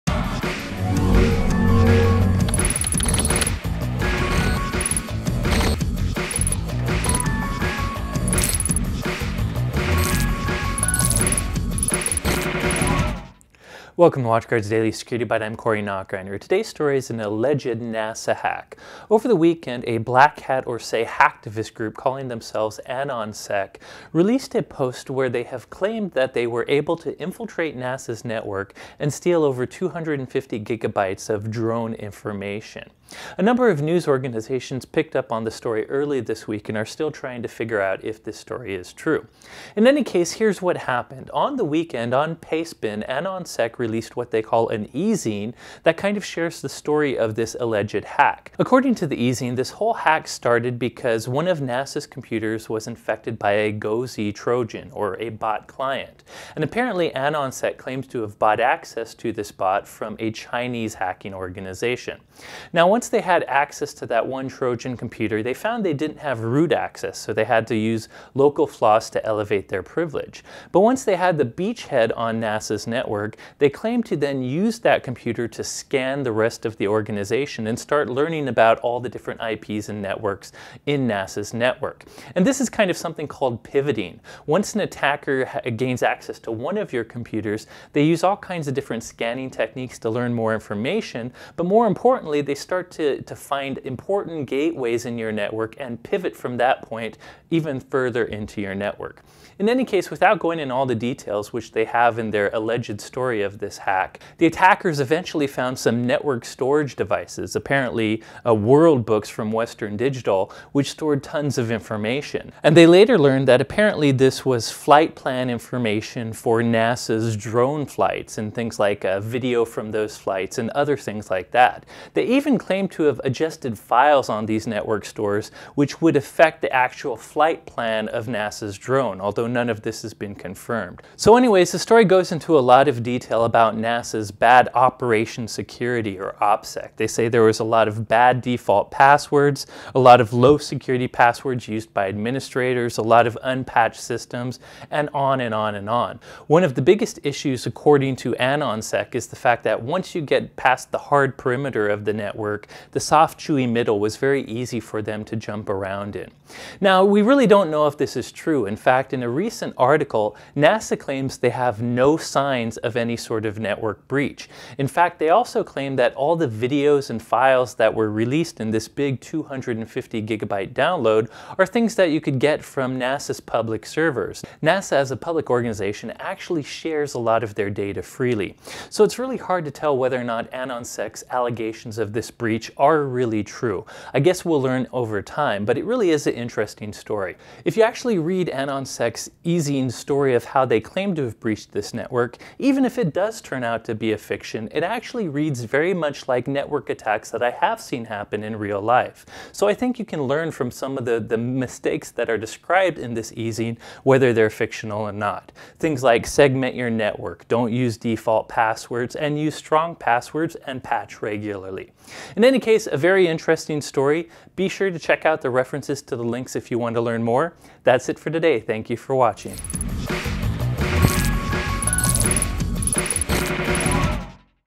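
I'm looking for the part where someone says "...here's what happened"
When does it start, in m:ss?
0:40.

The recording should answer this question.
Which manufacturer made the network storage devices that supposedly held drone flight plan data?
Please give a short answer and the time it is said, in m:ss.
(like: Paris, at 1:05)
Western Digital, at 1:49.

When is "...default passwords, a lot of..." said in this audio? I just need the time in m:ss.
2:18.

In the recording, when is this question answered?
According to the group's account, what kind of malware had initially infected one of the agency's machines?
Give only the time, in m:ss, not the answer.
0:53.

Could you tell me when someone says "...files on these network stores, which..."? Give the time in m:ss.
2:03.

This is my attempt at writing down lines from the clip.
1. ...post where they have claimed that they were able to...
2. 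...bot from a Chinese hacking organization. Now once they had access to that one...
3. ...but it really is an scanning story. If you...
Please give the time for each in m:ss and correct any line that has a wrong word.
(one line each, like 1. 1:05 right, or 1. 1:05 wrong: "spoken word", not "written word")
1. 0:24 right
2. 0:59 right
3. 3:05 wrong: "interesting", not "scanning".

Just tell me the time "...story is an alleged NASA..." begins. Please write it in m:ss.
0:16.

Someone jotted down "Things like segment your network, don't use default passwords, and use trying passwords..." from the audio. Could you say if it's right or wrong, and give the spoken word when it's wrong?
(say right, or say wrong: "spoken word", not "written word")
wrong: "strong", not "trying".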